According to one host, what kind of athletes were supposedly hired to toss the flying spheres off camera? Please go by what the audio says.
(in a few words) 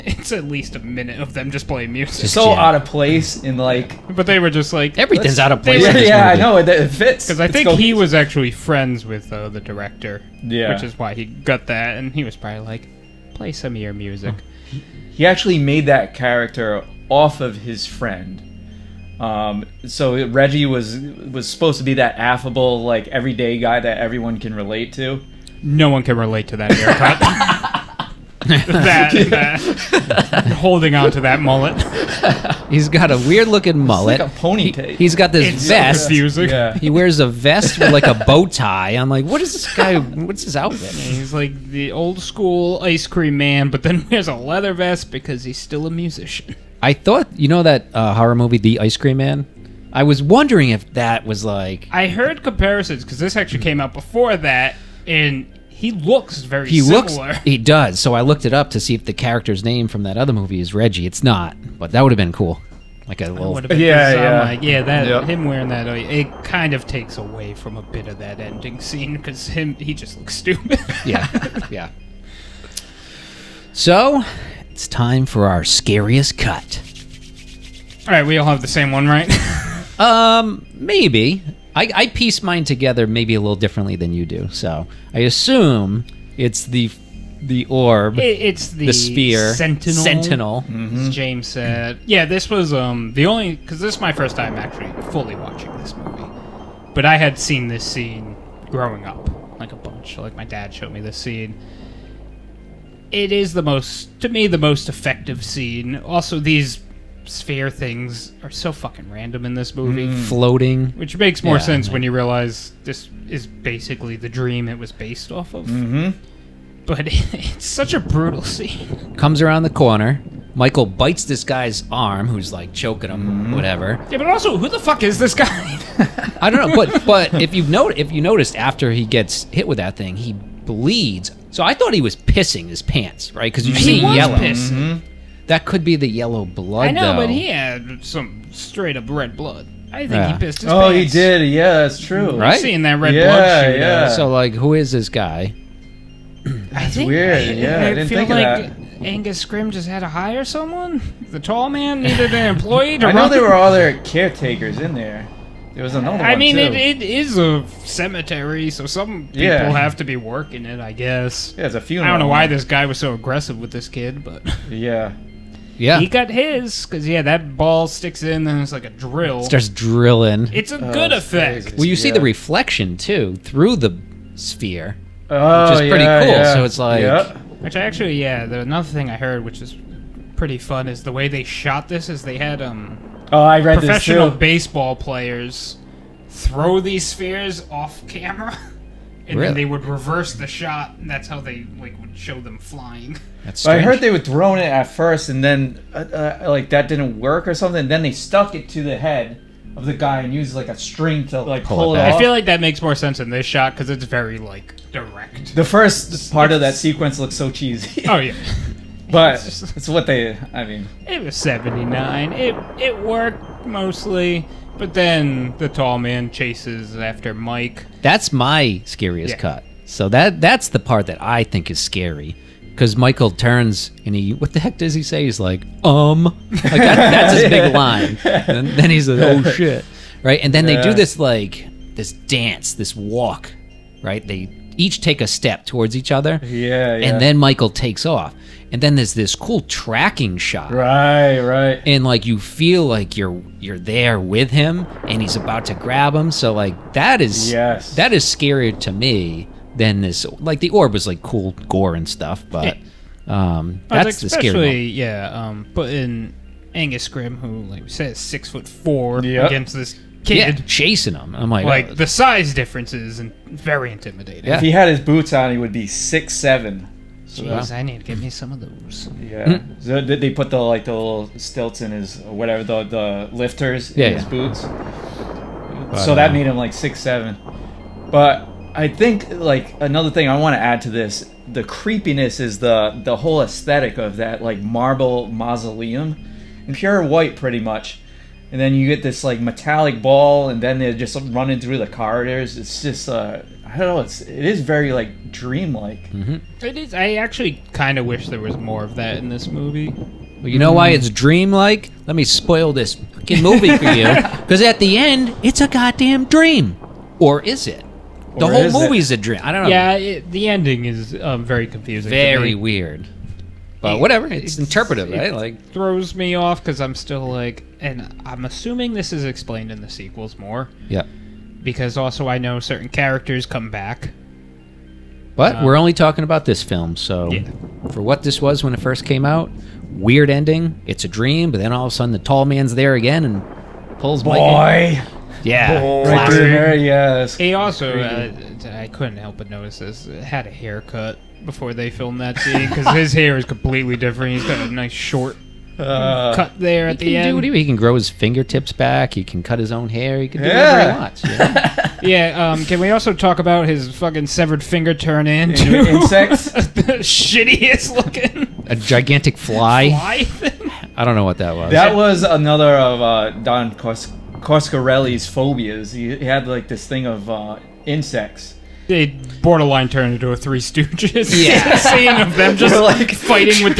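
professional baseball players.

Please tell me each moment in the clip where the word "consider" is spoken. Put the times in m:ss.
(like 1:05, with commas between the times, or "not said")
not said.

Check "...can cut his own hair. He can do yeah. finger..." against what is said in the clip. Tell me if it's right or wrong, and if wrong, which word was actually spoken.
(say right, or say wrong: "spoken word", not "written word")
wrong: "whatever", not "finger".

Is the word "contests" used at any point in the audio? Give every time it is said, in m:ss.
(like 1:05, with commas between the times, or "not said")
not said.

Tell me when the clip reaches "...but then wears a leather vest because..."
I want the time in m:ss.
0:43.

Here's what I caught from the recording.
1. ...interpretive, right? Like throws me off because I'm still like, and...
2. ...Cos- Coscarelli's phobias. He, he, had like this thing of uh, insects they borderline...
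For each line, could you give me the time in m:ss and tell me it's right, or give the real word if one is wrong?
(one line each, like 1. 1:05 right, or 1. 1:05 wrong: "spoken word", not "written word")
1. 5:14 right
2. 6:03 right.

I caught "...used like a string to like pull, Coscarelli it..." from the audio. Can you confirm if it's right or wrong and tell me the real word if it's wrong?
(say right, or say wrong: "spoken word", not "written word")
wrong: "Pull", not "Coscarelli".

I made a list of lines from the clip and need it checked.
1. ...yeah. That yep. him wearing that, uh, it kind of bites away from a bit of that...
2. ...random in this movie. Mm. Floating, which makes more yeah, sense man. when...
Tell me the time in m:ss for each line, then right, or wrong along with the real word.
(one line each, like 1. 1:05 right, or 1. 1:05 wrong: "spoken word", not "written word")
1. 1:04 wrong: "takes", not "bites"
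2. 1:49 right.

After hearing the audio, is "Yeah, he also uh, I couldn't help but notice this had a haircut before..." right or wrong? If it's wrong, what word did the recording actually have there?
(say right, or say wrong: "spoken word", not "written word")
right.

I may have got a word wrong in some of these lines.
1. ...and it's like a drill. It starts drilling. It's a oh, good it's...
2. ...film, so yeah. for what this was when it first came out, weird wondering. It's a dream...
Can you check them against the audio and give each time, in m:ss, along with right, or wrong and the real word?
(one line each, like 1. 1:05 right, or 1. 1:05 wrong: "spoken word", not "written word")
1. 2:48 right
2. 5:26 wrong: "ending", not "wondering".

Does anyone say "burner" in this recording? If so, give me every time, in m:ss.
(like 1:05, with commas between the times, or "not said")
not said.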